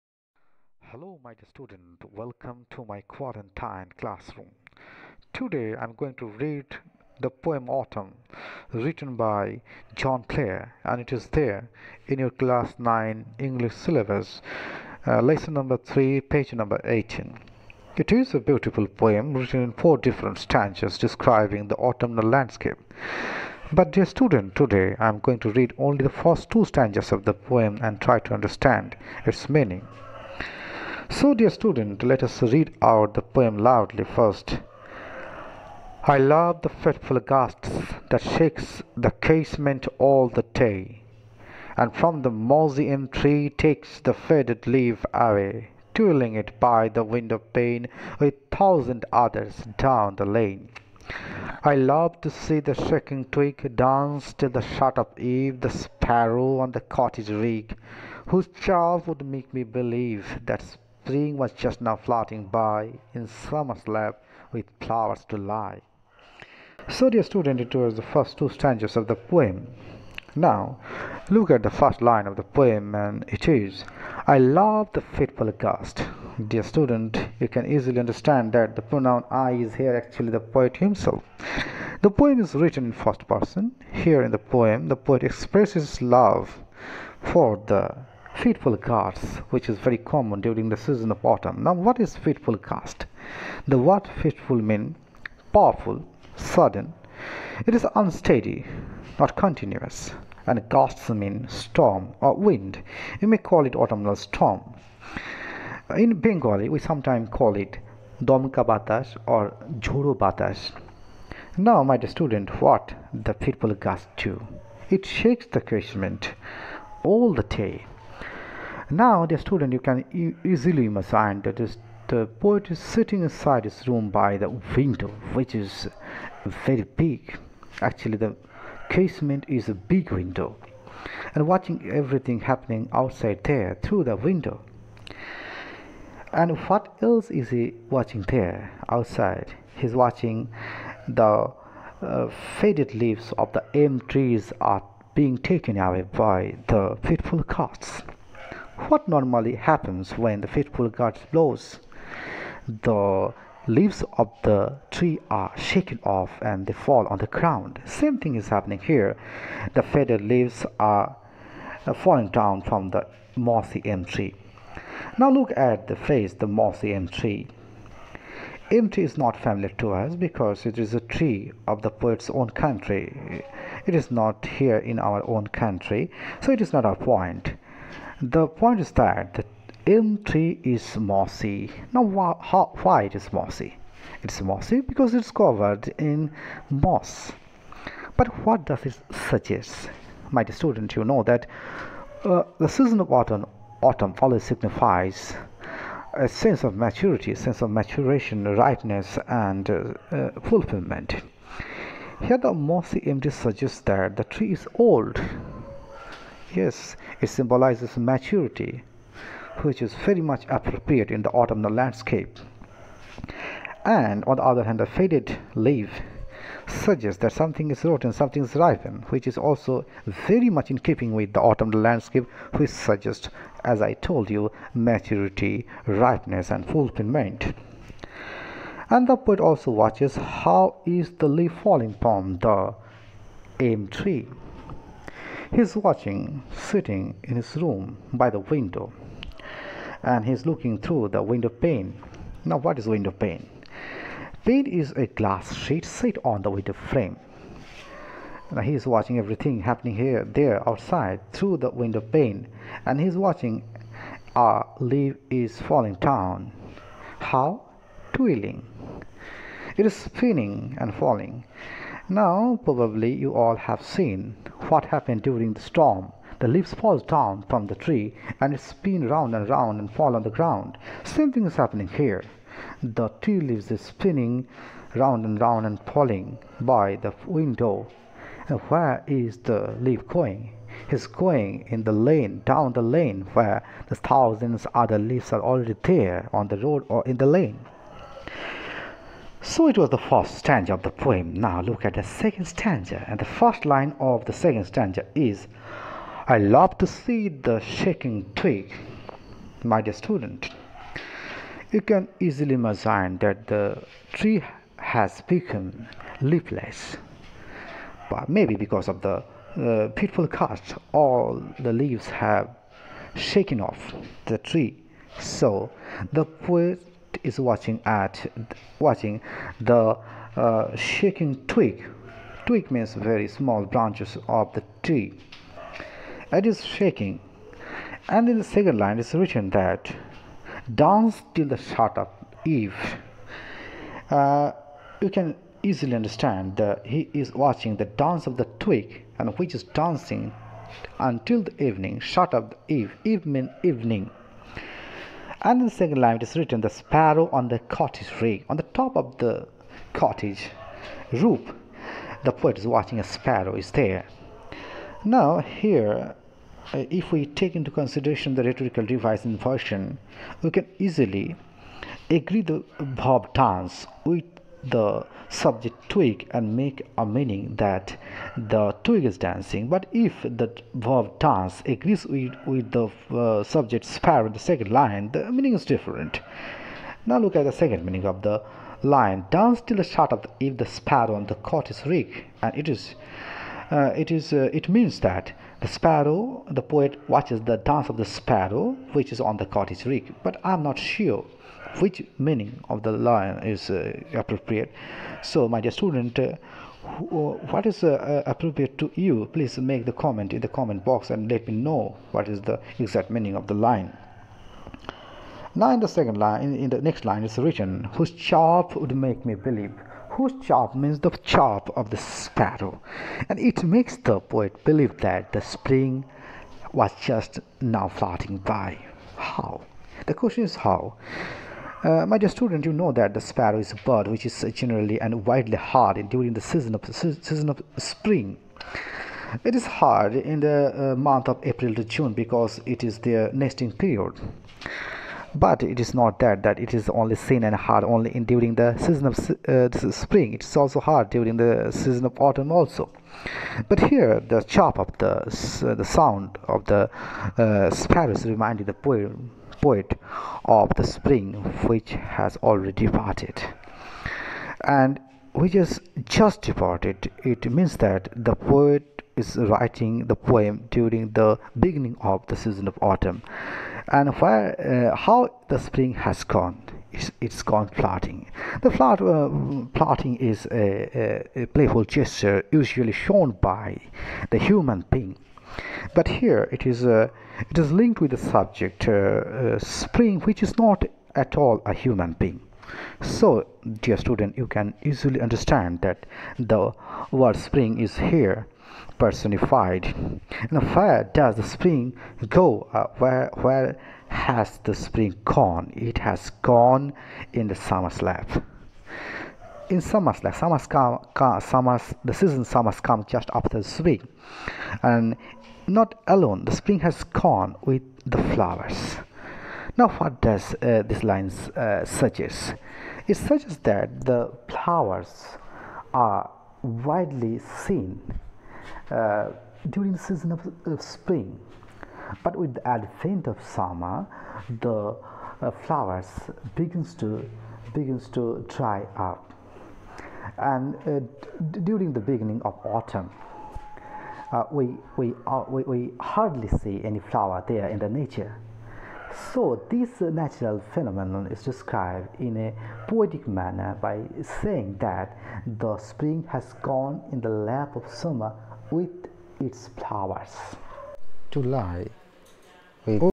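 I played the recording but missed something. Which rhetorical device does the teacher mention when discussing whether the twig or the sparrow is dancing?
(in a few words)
inversion.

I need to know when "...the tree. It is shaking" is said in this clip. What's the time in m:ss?
5:24.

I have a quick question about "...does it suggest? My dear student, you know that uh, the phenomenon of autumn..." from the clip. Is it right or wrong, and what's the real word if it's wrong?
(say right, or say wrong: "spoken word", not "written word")
wrong: "season", not "phenomenon".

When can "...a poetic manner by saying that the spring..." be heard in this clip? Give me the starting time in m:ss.
9:02.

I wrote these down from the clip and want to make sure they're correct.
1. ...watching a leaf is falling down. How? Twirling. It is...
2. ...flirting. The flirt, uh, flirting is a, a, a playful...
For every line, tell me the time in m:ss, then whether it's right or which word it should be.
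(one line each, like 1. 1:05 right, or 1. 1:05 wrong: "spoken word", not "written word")
1. 4:13 right
2. 7:47 right.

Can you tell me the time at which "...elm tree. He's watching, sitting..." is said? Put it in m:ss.
3:53.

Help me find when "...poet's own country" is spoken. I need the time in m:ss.
2:51.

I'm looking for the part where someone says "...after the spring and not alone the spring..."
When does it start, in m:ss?
8:23.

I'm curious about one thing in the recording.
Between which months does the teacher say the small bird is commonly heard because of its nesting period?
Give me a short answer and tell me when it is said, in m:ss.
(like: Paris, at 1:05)
April to June, at 7:11.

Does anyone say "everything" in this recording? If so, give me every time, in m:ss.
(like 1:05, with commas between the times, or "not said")
2:11, 4:09.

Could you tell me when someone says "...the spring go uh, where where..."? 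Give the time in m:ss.
8:11.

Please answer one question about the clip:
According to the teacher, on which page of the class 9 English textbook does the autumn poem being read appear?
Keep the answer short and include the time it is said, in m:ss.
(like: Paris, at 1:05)
18, at 0:16.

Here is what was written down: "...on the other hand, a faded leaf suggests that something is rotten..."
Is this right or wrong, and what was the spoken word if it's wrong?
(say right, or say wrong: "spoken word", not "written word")
right.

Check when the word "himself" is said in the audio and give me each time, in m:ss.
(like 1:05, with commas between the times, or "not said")
1:20.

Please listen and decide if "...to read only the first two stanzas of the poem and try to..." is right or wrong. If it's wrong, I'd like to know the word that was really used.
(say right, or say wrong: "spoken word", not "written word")
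right.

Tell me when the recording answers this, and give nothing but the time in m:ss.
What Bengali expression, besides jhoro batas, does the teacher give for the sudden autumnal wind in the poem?
1:48.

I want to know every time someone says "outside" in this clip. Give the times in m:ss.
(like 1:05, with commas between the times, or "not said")
2:12, 2:18, 4:10.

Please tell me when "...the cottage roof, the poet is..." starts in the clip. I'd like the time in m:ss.
5:49.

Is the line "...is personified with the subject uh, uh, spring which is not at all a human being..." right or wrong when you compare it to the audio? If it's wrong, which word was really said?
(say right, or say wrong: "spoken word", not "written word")
wrong: "linked", not "personified".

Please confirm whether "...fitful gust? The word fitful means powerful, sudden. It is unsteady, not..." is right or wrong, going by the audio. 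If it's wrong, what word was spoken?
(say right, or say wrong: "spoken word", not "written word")
right.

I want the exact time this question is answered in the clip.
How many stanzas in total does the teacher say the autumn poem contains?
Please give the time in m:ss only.
0:19.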